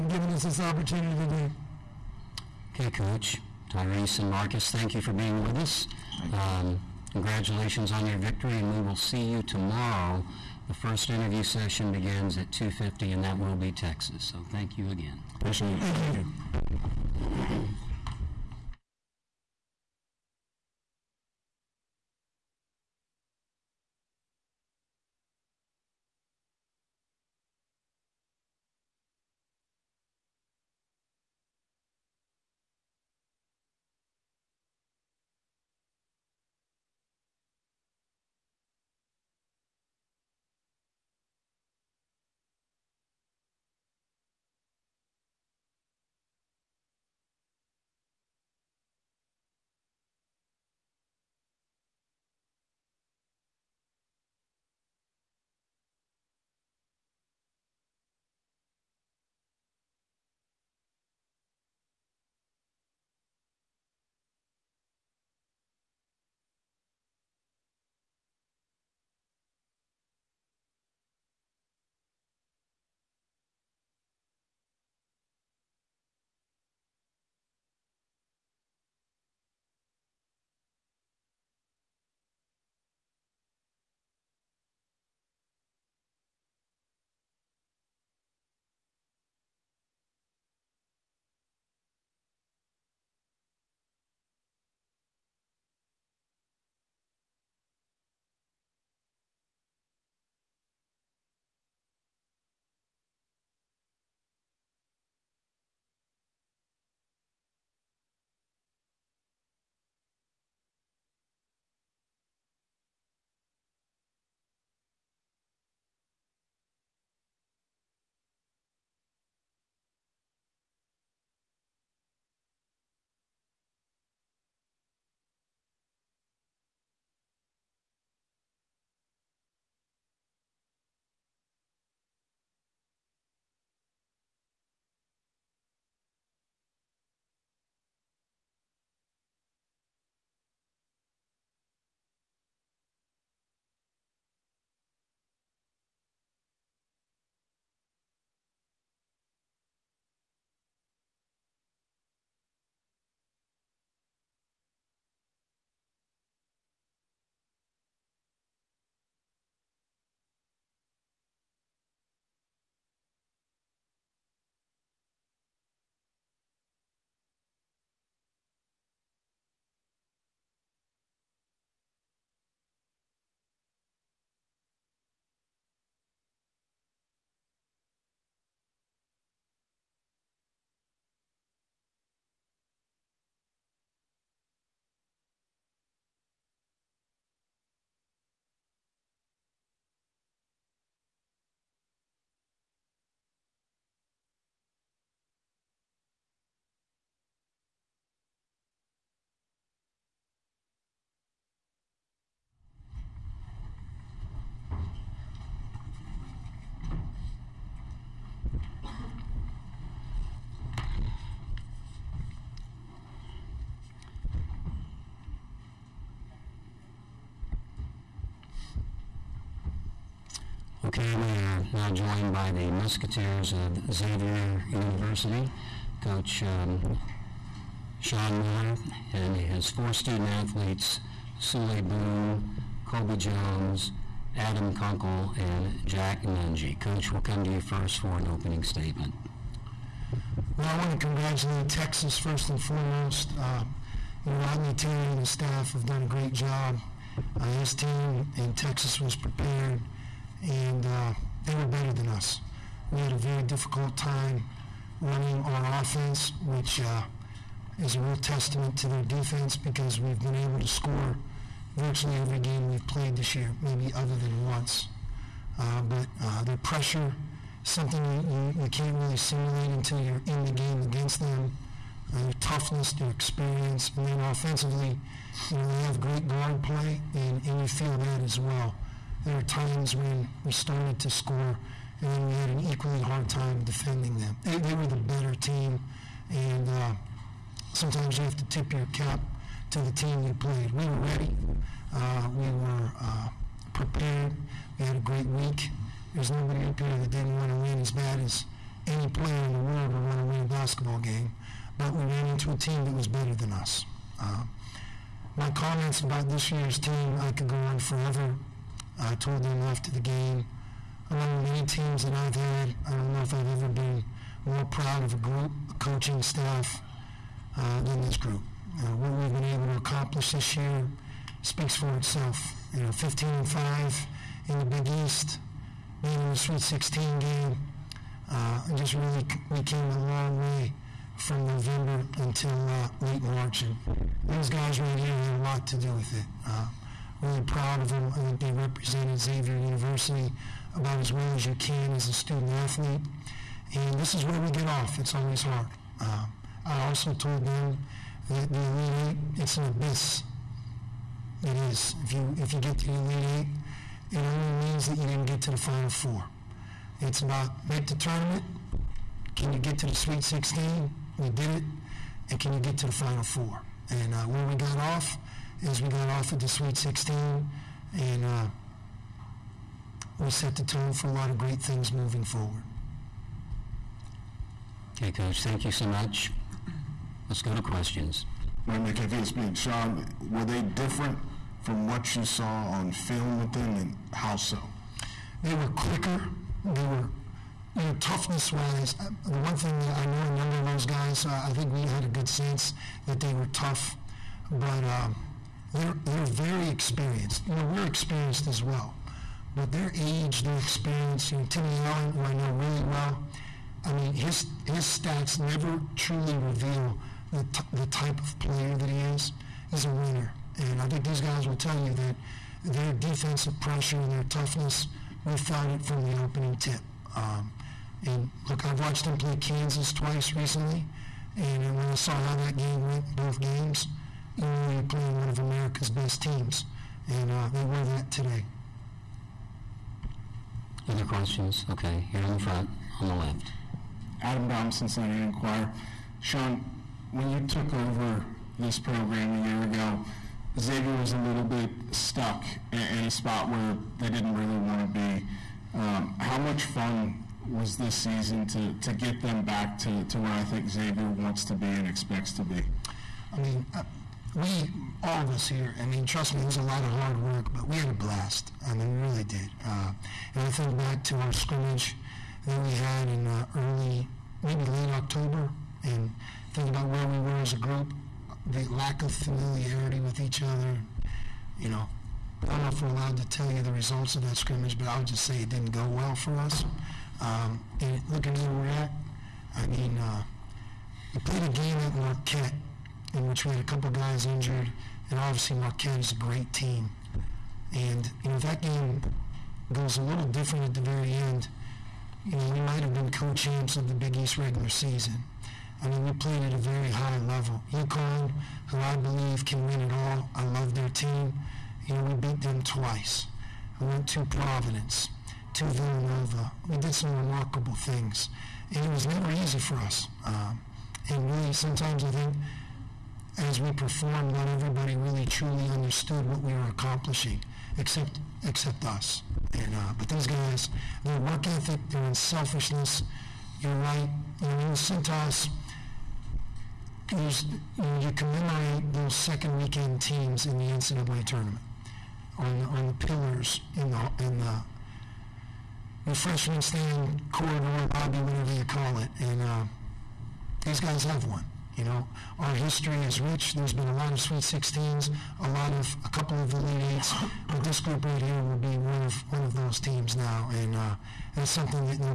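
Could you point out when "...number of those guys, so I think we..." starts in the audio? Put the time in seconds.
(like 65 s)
390 s.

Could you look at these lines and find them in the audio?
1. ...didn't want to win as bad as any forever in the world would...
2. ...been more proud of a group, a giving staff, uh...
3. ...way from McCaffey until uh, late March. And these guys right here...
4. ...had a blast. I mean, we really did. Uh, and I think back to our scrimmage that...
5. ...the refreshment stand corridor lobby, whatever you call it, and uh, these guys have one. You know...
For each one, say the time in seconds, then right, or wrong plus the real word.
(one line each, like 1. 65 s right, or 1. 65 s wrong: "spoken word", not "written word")
1. 297 s wrong: "player", not "forever"
2. 313 s wrong: "coaching", not "giving"
3. 330 s wrong: "November", not "McCaffey"
4. 457 s right
5. 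534 s right.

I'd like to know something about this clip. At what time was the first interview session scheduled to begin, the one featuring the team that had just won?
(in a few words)
2:50.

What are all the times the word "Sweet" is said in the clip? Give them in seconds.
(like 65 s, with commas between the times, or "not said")
326 s, 359 s, 366 s, 544 s.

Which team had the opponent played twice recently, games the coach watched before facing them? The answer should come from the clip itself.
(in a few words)
Kansas.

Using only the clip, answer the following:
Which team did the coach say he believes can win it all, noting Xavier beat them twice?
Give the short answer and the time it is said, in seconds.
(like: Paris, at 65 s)
UConn, at 497 s.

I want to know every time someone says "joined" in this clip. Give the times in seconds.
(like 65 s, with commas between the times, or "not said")
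221 s.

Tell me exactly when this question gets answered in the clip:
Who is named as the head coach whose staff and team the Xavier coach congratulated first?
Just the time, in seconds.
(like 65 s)
244 s.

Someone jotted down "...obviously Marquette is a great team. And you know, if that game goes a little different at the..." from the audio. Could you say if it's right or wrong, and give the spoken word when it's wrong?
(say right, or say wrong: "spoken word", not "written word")
right.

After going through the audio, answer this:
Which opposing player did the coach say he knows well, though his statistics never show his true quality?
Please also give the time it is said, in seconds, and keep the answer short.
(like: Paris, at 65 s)
Timmy Allen, at 401 s.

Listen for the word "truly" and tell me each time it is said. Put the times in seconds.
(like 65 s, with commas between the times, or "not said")
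405 s, 515 s.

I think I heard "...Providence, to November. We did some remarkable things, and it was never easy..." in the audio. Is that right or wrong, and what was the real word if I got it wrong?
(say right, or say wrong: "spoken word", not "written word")
wrong: "Villanova", not "November".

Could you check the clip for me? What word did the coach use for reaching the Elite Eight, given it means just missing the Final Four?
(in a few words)
An abyss.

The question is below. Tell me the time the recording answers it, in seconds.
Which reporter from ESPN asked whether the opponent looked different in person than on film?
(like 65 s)
378 s.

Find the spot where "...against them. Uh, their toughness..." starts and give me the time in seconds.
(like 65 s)
270 s.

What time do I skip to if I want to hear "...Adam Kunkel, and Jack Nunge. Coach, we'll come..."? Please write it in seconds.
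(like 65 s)
234 s.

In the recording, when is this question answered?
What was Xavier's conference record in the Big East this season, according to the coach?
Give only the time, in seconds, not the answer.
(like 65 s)
322 s.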